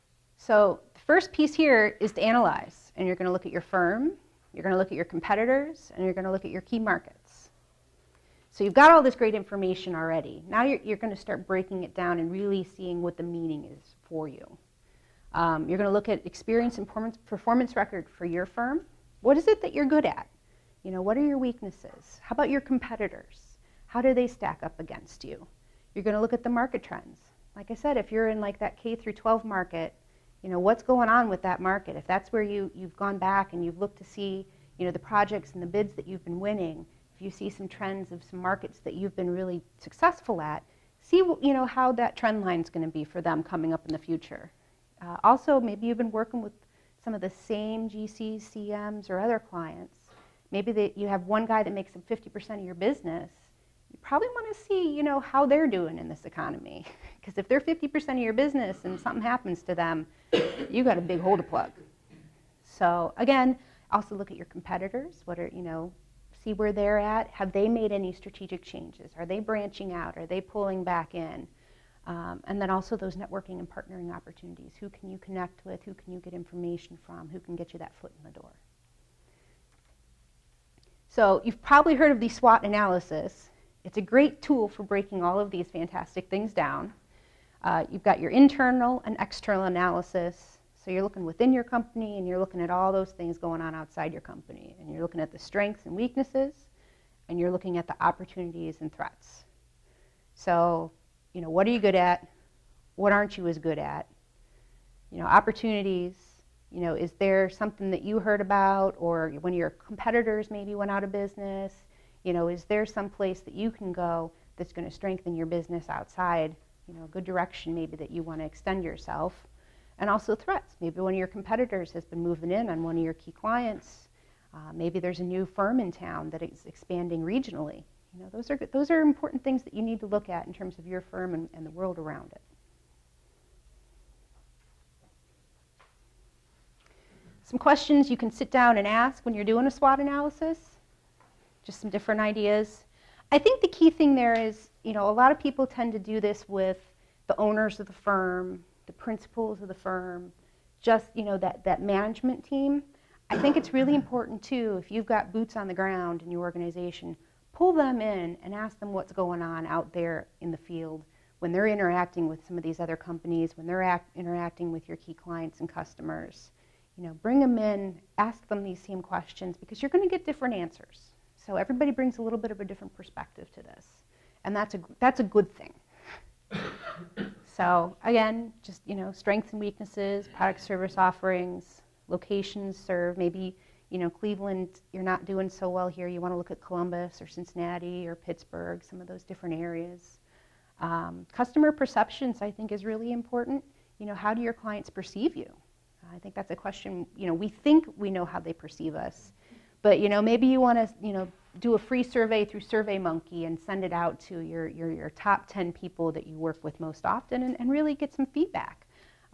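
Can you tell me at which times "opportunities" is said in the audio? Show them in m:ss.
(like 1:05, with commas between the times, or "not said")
1:14, 1:37, 1:45.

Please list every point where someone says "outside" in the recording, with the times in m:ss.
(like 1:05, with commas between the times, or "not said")
1:33, 1:55.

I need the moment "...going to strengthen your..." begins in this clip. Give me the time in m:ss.
1:54.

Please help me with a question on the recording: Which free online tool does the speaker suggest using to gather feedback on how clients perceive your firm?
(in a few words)
SurveyMonkey.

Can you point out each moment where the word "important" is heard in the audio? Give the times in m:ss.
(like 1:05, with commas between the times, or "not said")
2:09, 2:33, 3:13.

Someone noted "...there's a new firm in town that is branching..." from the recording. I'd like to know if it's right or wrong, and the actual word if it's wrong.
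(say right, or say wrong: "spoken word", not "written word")
wrong: "expanding", not "branching".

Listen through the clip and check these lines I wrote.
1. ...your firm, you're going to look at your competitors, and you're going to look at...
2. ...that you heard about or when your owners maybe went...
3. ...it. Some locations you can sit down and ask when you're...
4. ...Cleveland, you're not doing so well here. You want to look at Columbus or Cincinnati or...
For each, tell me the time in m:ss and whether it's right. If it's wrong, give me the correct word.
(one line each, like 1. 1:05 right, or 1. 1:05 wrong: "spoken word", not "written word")
1. 0:03 right
2. 1:47 wrong: "competitors", not "owners"
3. 2:12 wrong: "questions", not "locations"
4. 3:04 right.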